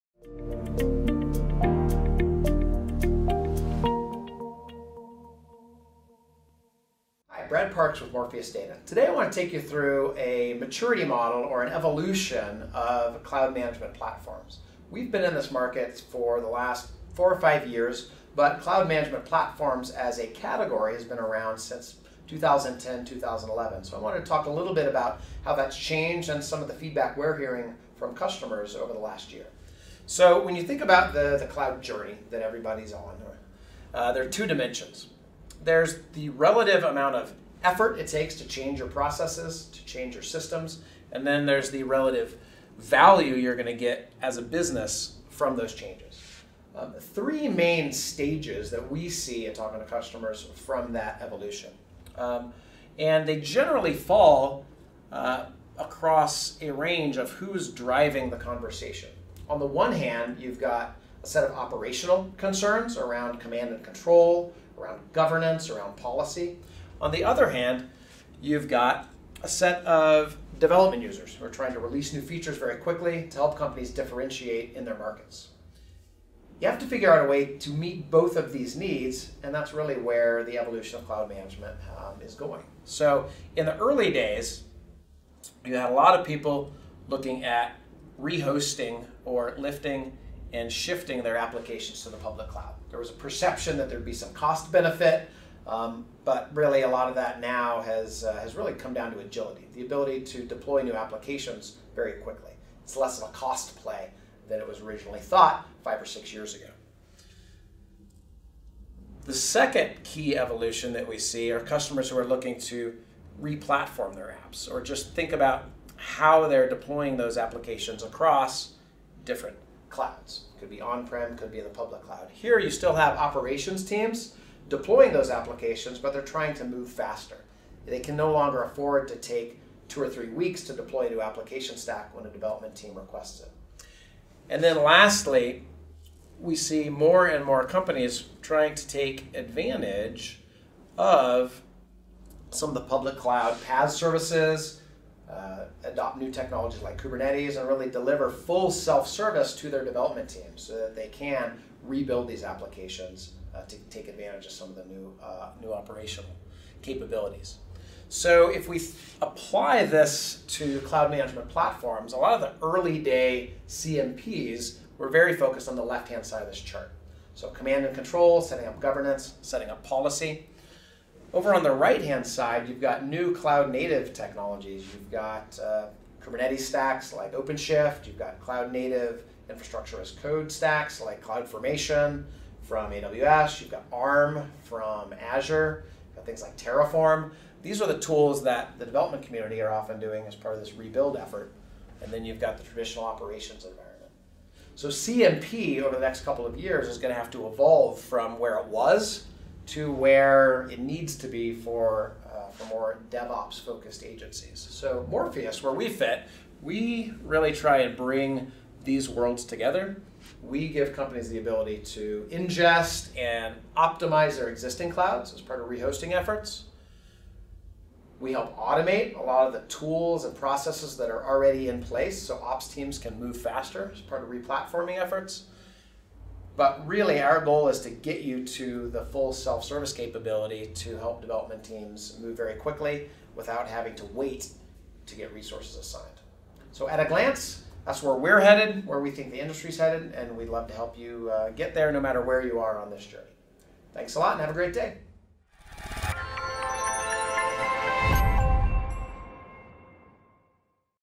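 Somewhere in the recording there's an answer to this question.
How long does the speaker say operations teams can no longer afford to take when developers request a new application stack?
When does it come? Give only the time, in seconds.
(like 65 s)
129 s.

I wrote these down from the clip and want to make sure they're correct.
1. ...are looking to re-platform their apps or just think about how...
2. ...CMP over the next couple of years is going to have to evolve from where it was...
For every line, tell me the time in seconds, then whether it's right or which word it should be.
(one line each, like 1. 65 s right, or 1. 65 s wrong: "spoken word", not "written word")
1. 112 s right
2. 194 s right.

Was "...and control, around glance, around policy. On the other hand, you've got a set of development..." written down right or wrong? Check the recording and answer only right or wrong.
wrong.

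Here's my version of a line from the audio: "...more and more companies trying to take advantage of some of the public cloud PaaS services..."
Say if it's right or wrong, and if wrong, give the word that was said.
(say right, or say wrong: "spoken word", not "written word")
right.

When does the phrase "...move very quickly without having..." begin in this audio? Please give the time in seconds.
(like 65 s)
232 s.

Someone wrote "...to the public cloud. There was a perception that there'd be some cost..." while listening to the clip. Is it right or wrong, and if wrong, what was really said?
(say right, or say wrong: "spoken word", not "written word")
right.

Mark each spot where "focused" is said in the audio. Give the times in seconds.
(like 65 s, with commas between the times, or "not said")
165 s, 203 s.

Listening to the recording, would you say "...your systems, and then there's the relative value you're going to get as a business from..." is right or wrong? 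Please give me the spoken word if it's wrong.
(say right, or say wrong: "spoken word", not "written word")
right.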